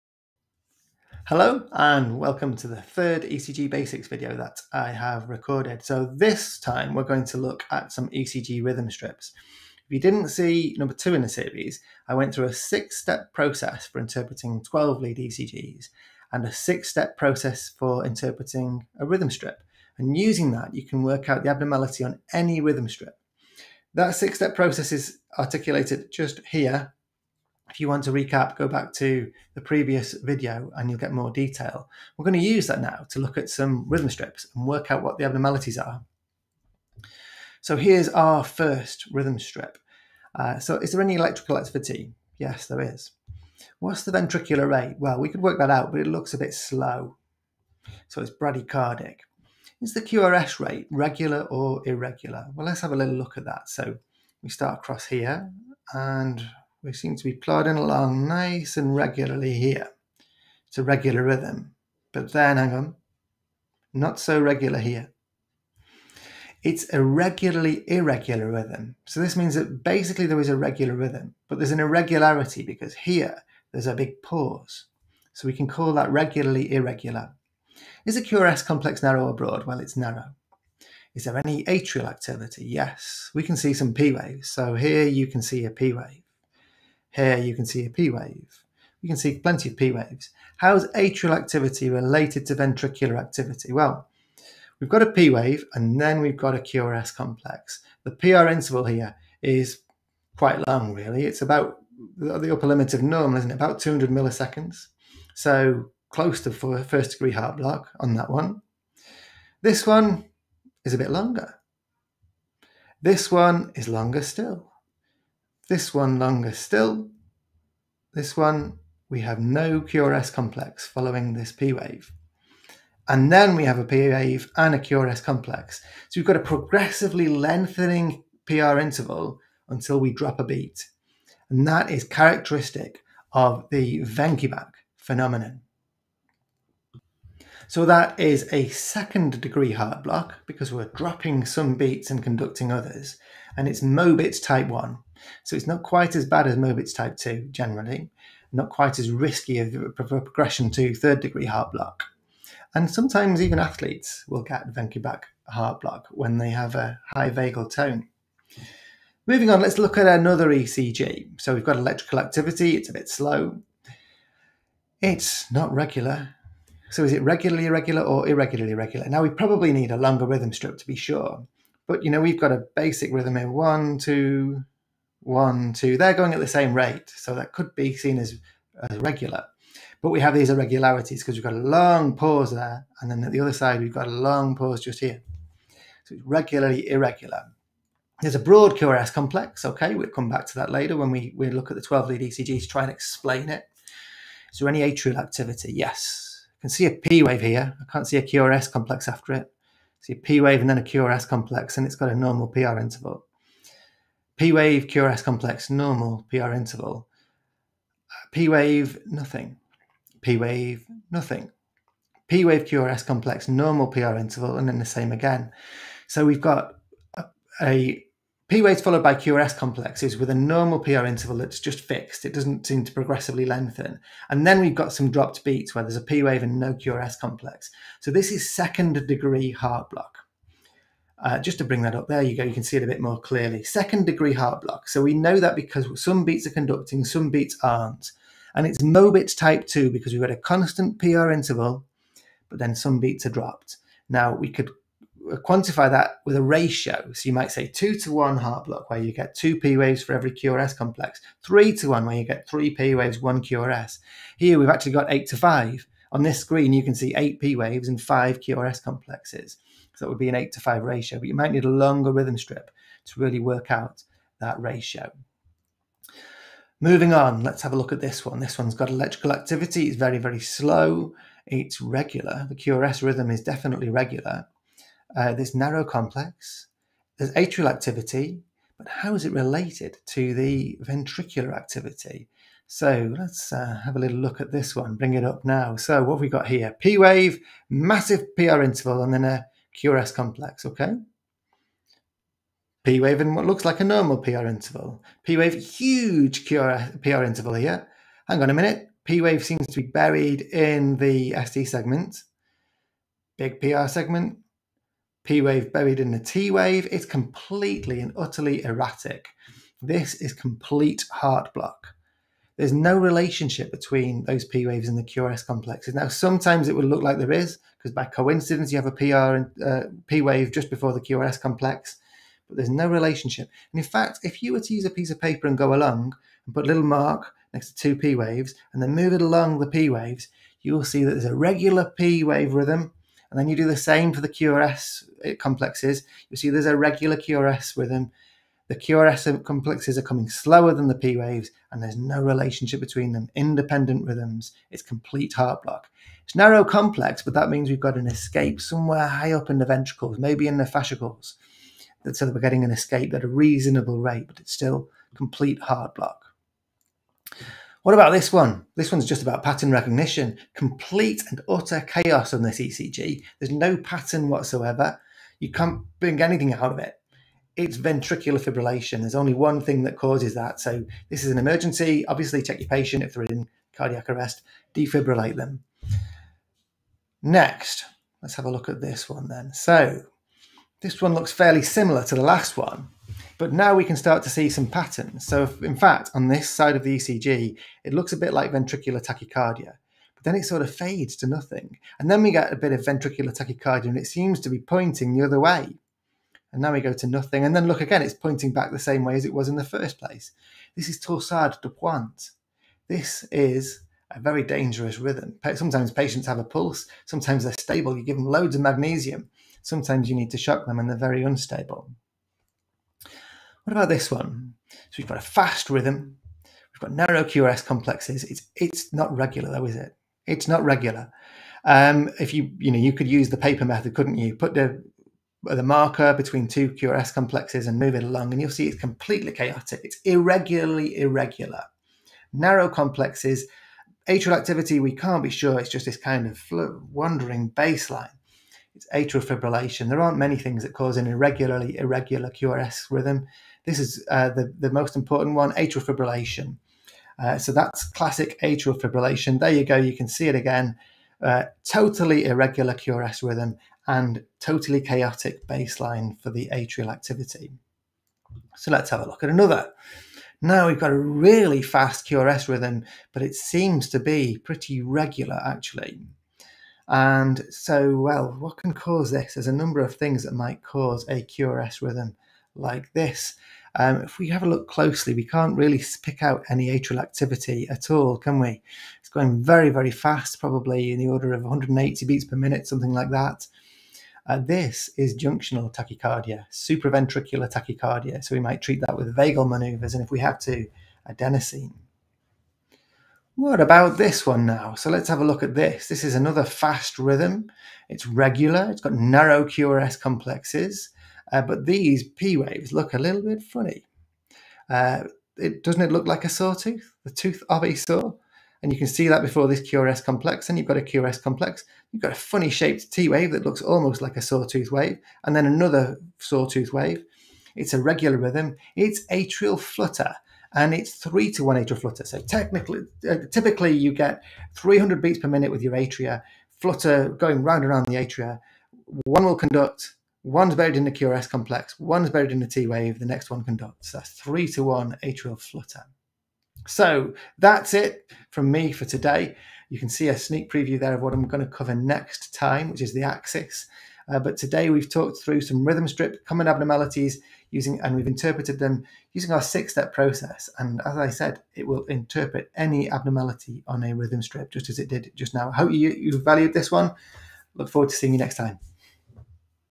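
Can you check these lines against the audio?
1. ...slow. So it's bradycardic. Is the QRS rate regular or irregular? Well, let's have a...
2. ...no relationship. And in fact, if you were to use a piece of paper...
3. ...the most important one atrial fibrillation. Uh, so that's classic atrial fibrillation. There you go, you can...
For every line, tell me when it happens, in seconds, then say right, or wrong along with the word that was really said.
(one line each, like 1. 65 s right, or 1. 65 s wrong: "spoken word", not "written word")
1. 46 s right
2. 322 s right
3. 444 s right.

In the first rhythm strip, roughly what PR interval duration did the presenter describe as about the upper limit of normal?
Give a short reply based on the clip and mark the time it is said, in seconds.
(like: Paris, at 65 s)
200 milliseconds, at 103 s.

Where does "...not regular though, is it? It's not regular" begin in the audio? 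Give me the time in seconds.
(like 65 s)
418 s.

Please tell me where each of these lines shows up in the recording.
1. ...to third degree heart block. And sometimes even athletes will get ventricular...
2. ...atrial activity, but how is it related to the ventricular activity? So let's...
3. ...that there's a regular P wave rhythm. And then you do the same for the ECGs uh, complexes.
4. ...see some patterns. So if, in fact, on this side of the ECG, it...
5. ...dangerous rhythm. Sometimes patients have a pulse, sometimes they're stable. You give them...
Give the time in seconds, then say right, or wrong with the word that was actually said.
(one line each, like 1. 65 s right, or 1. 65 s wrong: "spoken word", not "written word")
1. 150 s right
2. 277 s right
3. 331 s wrong: "QRS", not "ECGs"
4. 384 s right
5. 404 s right.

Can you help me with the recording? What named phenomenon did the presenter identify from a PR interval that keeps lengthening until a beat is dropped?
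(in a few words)
Wenckebach phenomenon.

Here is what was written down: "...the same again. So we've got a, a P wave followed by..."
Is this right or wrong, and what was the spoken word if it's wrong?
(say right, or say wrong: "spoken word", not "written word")
right.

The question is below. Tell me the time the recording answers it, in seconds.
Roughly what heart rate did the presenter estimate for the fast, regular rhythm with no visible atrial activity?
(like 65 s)
481 s.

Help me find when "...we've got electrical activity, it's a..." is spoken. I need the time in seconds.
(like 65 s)
161 s.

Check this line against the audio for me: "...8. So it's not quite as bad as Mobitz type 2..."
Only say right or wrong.
wrong.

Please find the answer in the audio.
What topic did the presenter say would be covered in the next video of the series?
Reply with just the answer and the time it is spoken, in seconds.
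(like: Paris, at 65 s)
the axis, at 542 s.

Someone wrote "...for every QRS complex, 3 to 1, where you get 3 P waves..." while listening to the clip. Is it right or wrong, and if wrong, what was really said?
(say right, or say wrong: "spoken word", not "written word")
right.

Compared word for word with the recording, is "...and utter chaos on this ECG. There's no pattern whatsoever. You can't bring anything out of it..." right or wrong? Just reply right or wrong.
right.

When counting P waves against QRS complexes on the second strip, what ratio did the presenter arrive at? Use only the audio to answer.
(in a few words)
8 to 5.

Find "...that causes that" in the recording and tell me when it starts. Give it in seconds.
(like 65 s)
369 s.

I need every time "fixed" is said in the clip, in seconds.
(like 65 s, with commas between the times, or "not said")
221 s.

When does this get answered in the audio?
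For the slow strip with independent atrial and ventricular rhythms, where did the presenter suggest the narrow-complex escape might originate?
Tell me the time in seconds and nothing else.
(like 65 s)
350 s.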